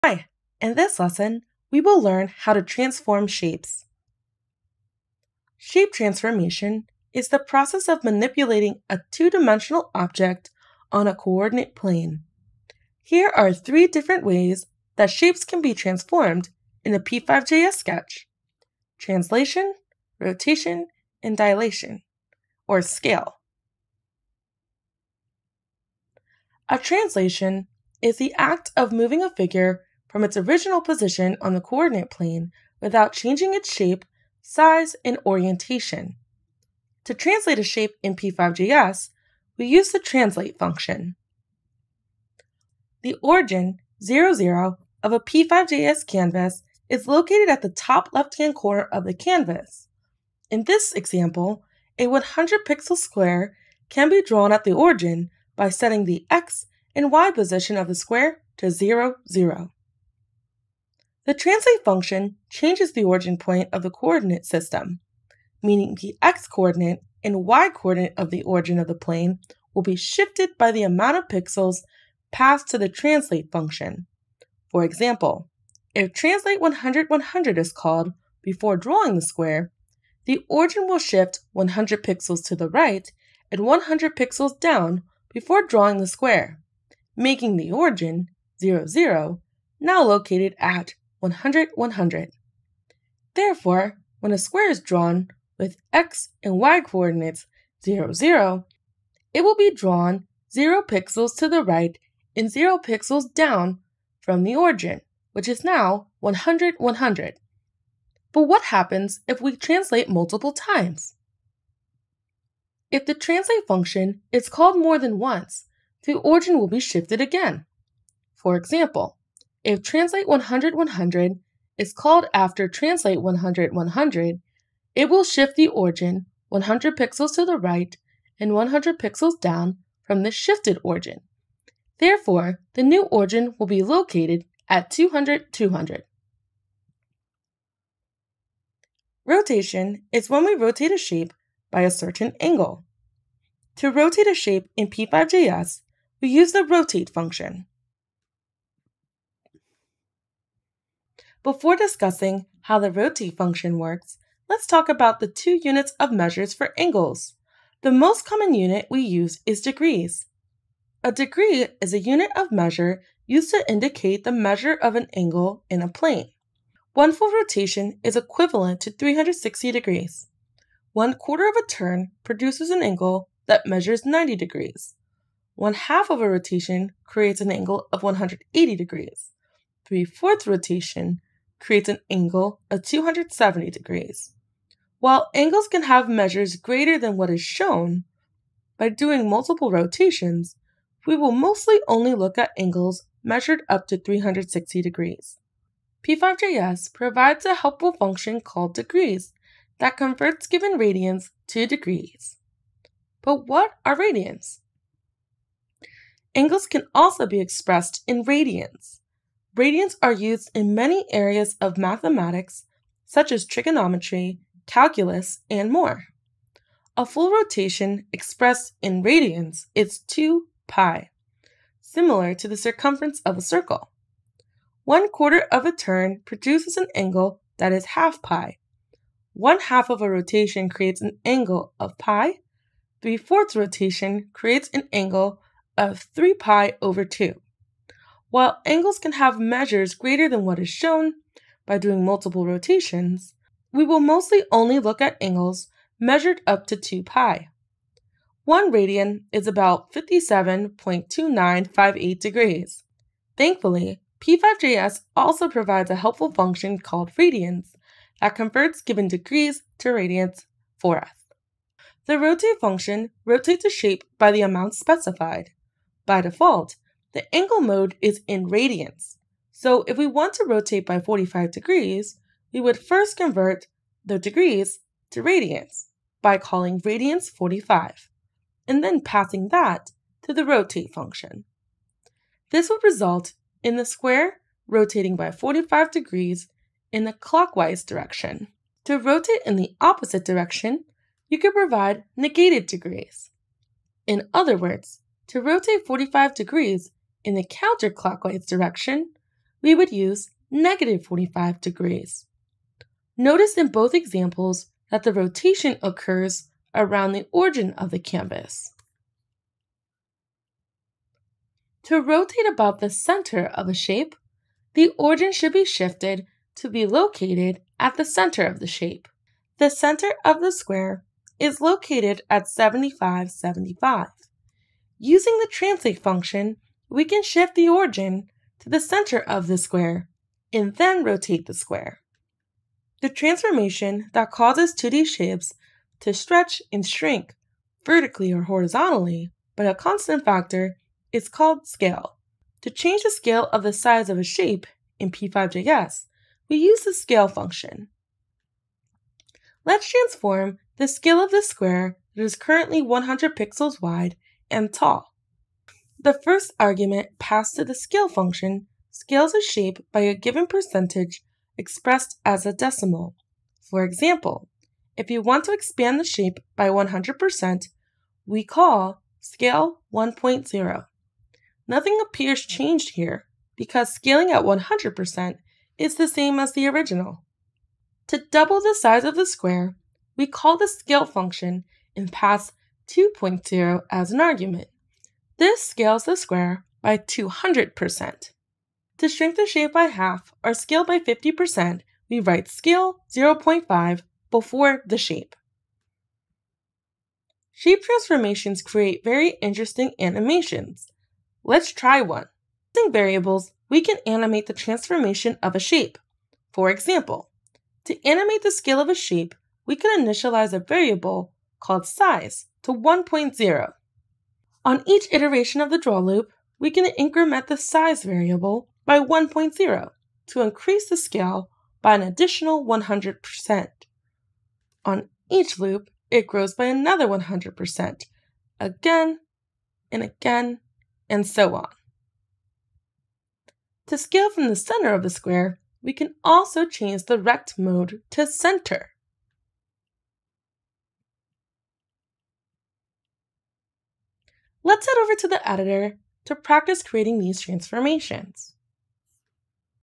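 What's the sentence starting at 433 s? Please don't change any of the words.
To scale from the center of the square, we can also change the rect mode to center.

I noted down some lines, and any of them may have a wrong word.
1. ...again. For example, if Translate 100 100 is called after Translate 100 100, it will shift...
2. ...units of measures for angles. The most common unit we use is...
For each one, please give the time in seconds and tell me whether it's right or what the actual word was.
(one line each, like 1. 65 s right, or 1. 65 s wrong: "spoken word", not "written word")
1. 117 s right
2. 155 s right.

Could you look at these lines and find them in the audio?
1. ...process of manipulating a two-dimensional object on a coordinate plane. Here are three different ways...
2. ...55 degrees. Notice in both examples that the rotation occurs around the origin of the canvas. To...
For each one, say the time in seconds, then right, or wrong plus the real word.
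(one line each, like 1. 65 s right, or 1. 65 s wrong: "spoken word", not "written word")
1. 7 s right
2. 301 s wrong: "45", not "55".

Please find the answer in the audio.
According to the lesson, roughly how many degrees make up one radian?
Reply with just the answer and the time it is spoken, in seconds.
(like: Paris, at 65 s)
57.2958 degrees, at 249 s.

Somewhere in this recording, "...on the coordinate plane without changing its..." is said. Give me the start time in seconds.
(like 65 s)
31 s.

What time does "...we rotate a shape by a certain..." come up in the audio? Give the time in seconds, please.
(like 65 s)
140 s.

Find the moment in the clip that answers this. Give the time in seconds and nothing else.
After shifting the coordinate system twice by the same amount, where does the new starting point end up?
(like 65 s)
134 s.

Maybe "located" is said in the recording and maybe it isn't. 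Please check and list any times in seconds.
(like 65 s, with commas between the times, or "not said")
47 s, 90 s, 133 s, 316 s, 321 s.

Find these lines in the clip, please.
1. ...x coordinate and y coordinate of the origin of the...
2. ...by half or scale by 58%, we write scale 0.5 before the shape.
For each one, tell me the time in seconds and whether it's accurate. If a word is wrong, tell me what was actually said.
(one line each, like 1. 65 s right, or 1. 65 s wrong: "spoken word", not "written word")
1. 66 s right
2. 389 s wrong: "50", not "58".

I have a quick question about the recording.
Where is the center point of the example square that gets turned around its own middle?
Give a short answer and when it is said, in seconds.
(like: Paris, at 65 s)
75, 75, at 322 s.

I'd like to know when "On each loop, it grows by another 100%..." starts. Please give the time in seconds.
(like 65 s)
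424 s.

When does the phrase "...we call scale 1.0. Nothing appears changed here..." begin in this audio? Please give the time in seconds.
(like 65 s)
368 s.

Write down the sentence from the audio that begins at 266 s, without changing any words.
By default, the angle mode is in radians.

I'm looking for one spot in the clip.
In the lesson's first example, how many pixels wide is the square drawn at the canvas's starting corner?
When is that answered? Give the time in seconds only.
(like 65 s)
52 s.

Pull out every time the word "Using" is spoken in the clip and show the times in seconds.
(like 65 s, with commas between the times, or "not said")
324 s, 402 s.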